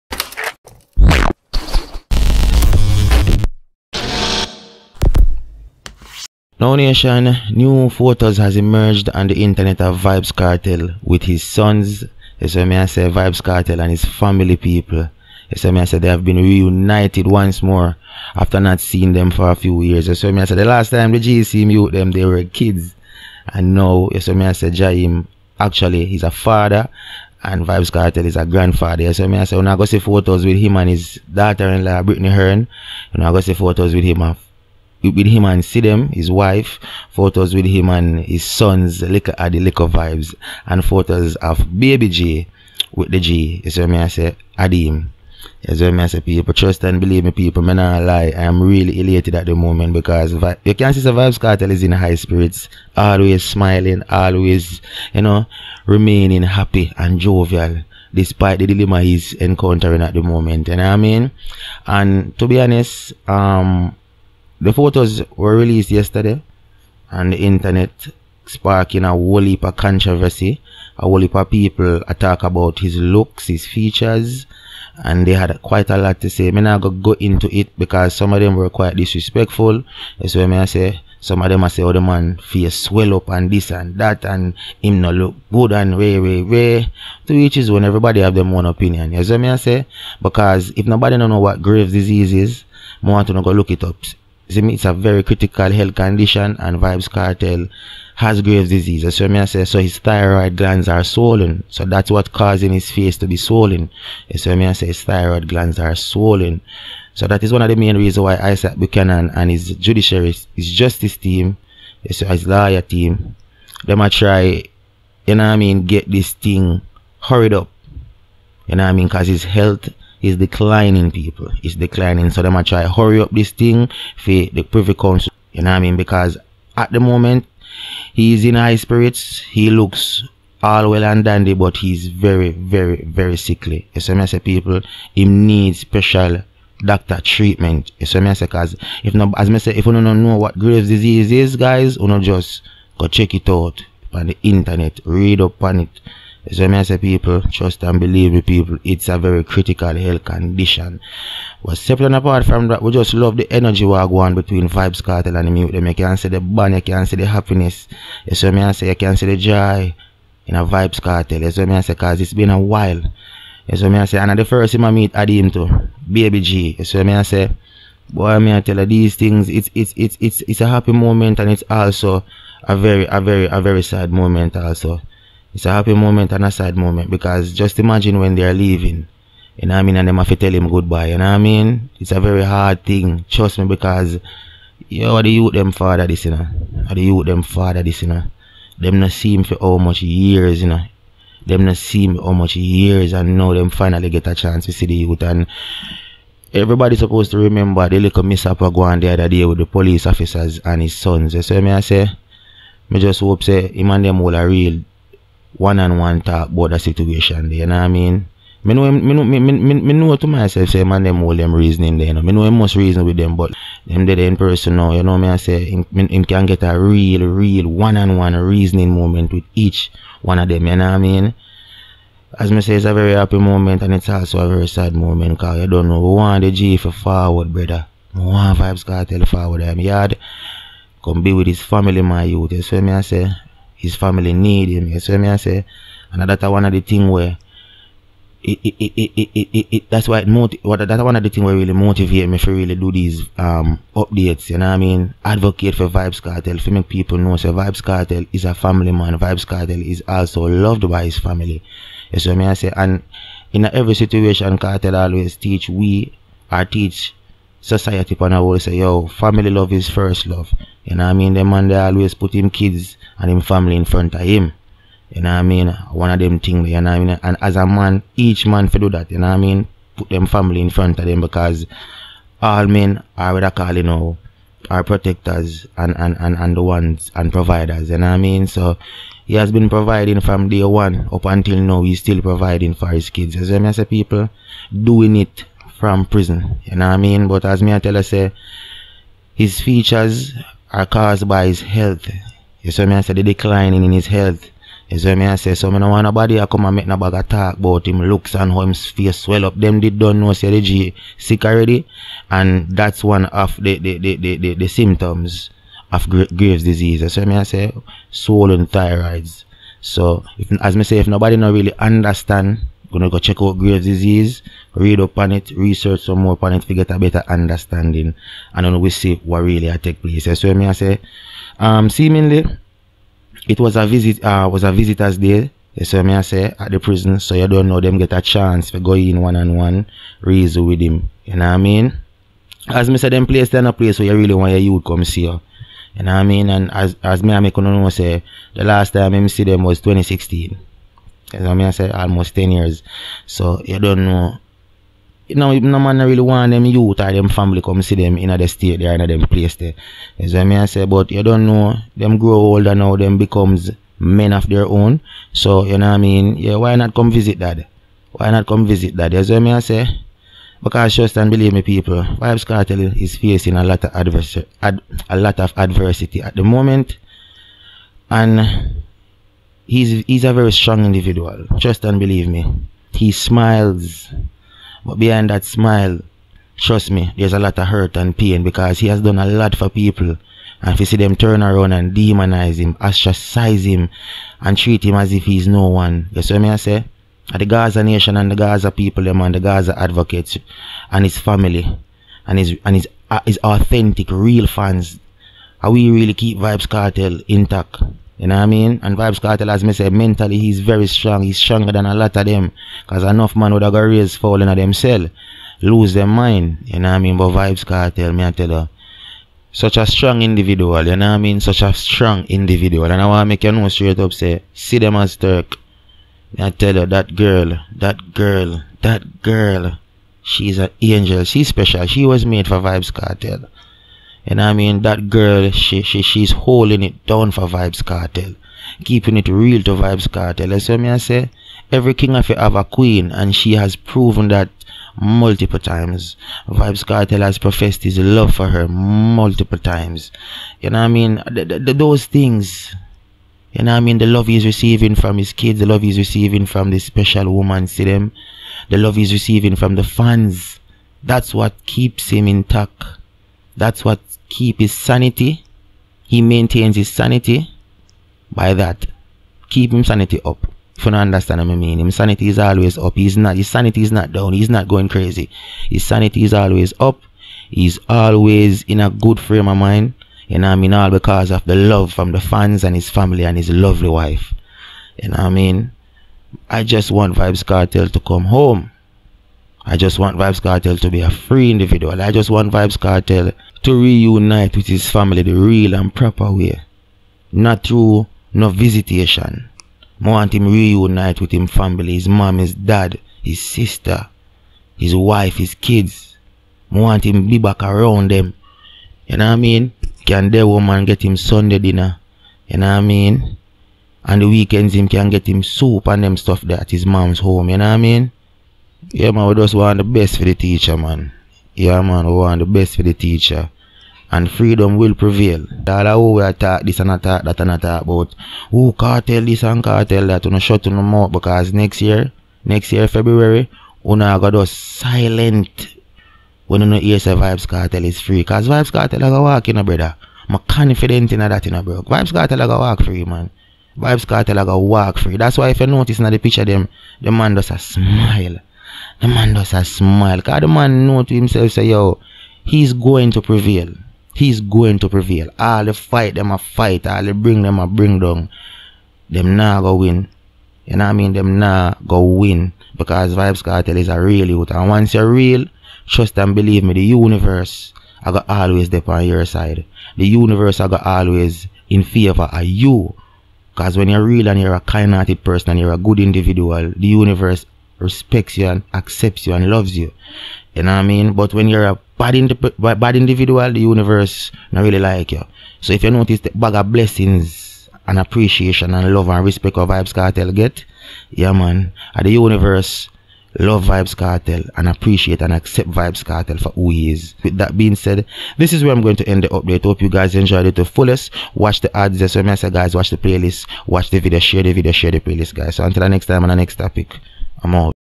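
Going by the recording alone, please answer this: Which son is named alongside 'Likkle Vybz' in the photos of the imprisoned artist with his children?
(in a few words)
Likkle Addi.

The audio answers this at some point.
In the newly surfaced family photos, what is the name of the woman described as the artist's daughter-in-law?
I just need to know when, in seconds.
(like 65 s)
32 s.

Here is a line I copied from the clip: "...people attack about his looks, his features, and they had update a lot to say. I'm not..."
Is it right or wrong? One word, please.
wrong.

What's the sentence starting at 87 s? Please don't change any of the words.
To which is when everybody have their own opinion.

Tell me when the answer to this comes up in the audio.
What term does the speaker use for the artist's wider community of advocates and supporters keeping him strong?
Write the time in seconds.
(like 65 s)
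387 s.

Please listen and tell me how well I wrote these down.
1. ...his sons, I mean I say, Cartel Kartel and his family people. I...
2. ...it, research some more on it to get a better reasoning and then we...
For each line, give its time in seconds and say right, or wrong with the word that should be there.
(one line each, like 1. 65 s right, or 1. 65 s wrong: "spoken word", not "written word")
1. 11 s wrong: "Vybz", not "Cartel"
2. 315 s wrong: "understanding", not "reasoning".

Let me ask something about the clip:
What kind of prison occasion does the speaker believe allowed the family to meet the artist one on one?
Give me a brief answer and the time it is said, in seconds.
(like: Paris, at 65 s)
Visitors day, at 324 s.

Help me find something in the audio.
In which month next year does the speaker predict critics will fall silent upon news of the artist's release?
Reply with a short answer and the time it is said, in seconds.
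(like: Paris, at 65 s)
February, at 522 s.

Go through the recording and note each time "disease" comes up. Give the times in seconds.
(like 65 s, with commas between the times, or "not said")
91 s, 98 s, 140 s, 306 s, 313 s.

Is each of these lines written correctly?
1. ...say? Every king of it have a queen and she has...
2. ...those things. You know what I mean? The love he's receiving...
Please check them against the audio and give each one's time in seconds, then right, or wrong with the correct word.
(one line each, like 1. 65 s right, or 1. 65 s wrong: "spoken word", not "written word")
1. 430 s right
2. 441 s right.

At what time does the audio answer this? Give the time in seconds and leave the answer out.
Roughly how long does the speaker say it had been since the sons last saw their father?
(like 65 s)
341 s.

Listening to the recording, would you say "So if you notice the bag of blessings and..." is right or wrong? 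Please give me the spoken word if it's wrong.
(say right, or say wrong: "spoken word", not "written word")
right.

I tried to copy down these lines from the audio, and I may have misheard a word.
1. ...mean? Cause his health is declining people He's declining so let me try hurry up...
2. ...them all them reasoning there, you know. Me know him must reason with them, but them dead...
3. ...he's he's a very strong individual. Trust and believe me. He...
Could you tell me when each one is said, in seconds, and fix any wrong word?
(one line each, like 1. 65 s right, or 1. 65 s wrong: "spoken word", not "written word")
1. 118 s right
2. 211 s right
3. 369 s right.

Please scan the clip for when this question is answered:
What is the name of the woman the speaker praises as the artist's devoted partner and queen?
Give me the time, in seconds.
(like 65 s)
414 s.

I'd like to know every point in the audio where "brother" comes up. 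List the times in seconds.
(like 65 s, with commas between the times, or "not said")
227 s, 529 s.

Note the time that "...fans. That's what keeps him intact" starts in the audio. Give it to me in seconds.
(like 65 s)
449 s.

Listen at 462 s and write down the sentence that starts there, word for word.
He's not his sanity is not down.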